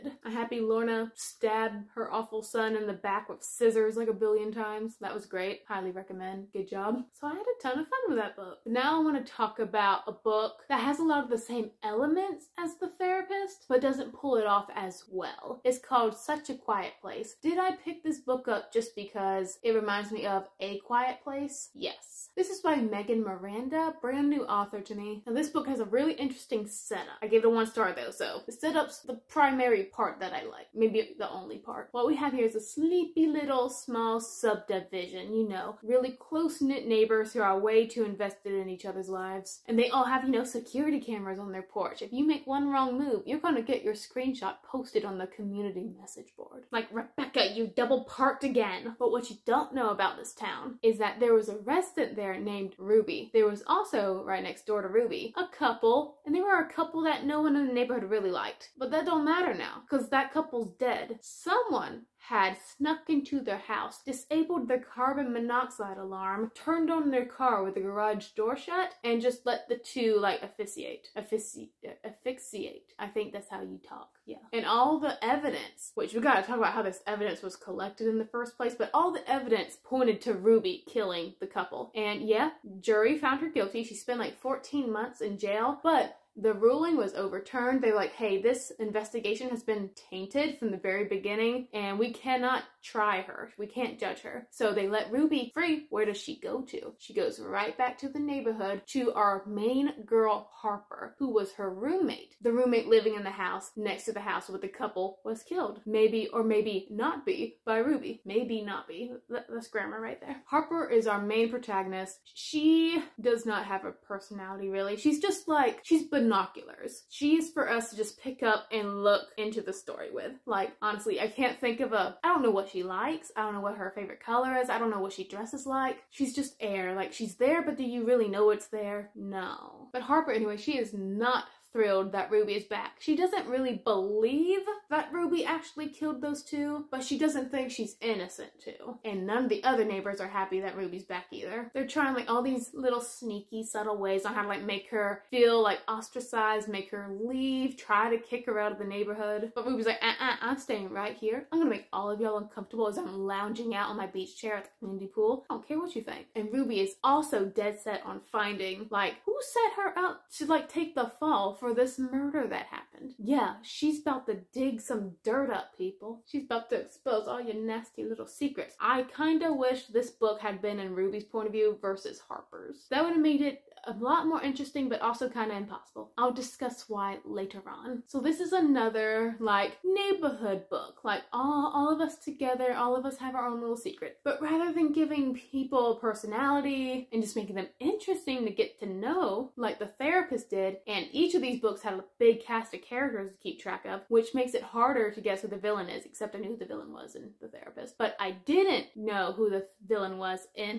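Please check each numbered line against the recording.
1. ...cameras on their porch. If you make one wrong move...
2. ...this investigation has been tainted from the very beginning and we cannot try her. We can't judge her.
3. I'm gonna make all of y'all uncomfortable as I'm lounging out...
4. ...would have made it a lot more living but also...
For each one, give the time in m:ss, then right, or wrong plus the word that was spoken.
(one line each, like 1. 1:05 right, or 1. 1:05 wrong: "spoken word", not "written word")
1. 0:41 right
2. 1:28 right
3. 2:31 right
4. 2:53 wrong: "interesting", not "living".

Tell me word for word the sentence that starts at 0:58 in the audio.
But that don't matter now, because that couple's dead.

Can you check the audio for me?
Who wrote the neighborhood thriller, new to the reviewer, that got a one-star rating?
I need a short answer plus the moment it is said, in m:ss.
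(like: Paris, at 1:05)
Megan Miranda, at 0:22.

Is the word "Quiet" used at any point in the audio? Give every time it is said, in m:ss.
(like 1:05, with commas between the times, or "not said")
0:16, 0:20.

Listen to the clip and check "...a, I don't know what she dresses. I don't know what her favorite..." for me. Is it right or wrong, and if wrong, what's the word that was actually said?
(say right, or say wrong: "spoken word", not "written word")
wrong: "likes", not "dresses".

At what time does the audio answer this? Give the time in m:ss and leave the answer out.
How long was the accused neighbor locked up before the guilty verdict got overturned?
1:24.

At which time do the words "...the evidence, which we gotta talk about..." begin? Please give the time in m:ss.
1:14.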